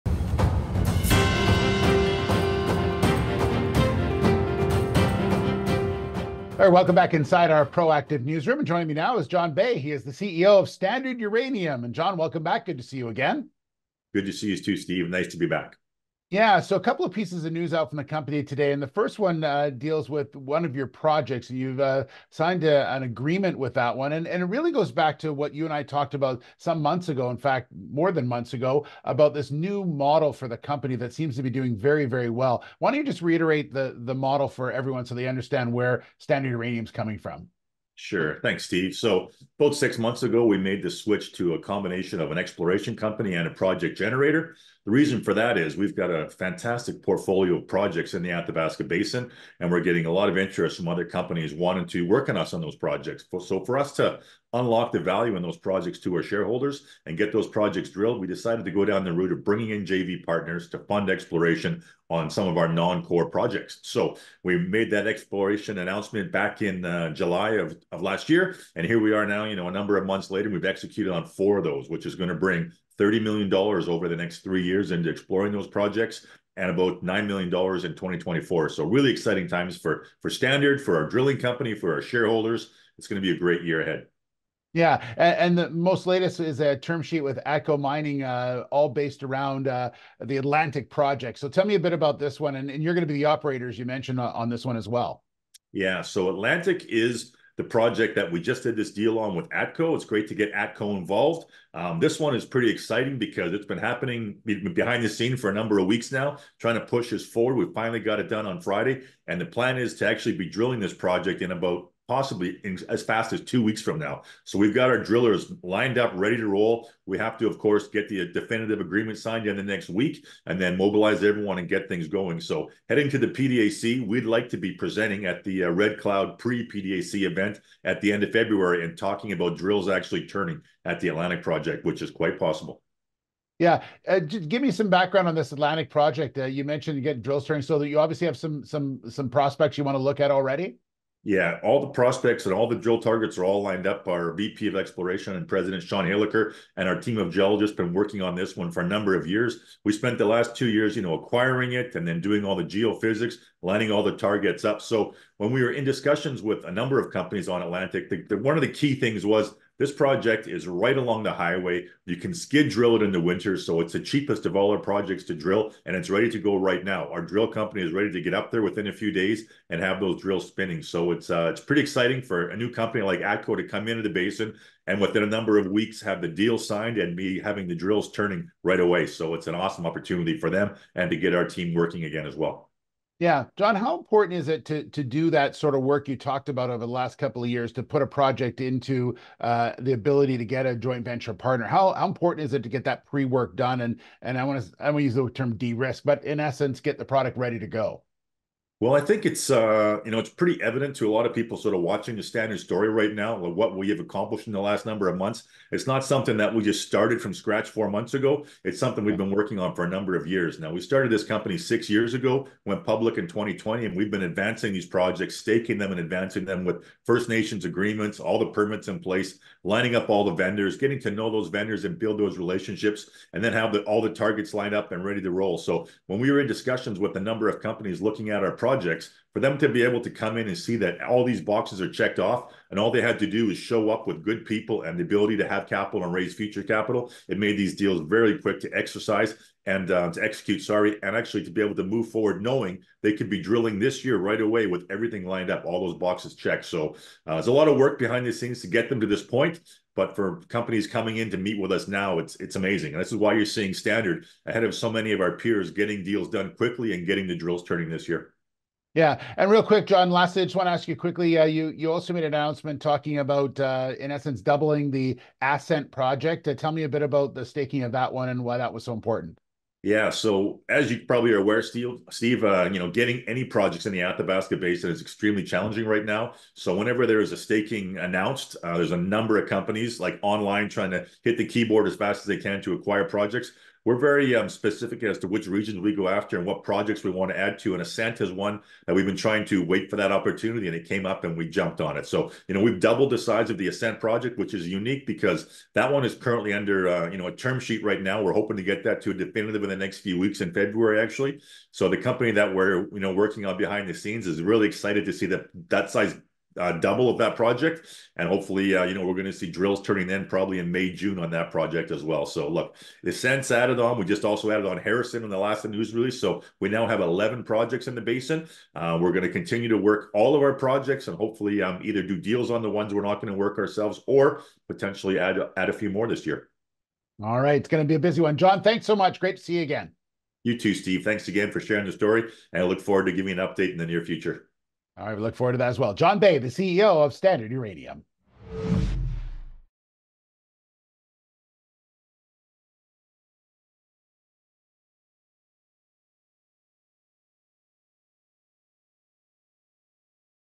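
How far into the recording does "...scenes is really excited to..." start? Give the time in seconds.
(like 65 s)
303 s.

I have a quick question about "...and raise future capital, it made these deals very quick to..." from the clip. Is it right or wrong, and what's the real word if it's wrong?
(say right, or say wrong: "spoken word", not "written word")
right.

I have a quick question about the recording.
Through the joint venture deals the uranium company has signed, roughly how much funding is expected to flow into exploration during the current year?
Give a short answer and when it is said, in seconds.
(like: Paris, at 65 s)
$9 million, at 77 s.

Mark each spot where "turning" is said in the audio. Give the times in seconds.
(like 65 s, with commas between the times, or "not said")
130 s, 137 s, 178 s, 257 s, 309 s.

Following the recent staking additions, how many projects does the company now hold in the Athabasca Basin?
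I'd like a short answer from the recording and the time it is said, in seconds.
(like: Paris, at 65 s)
11, at 317 s.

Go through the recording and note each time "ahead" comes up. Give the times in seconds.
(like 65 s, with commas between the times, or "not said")
83 s, 254 s.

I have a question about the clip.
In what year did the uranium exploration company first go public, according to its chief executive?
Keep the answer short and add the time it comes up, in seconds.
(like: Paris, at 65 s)
2020, at 213 s.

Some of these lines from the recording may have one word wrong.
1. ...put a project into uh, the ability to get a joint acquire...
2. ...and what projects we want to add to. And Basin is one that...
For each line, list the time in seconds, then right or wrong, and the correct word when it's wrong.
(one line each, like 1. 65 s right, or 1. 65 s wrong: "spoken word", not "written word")
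1. 187 s wrong: "venture", not "acquire"
2. 286 s wrong: "Ascent", not "Basin".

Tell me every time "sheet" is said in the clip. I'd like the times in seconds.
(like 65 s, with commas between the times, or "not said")
87 s, 297 s.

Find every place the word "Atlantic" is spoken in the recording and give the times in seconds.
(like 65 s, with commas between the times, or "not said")
90 s, 96 s, 131 s, 135 s, 157 s.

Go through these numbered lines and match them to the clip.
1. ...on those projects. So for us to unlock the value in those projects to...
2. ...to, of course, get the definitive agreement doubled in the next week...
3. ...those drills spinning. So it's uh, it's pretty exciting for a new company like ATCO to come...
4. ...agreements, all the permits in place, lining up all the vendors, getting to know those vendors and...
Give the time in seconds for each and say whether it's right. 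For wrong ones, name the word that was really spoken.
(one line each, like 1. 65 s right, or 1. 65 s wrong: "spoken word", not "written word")
1. 52 s right
2. 117 s wrong: "signed", not "doubled"
3. 169 s right
4. 217 s right.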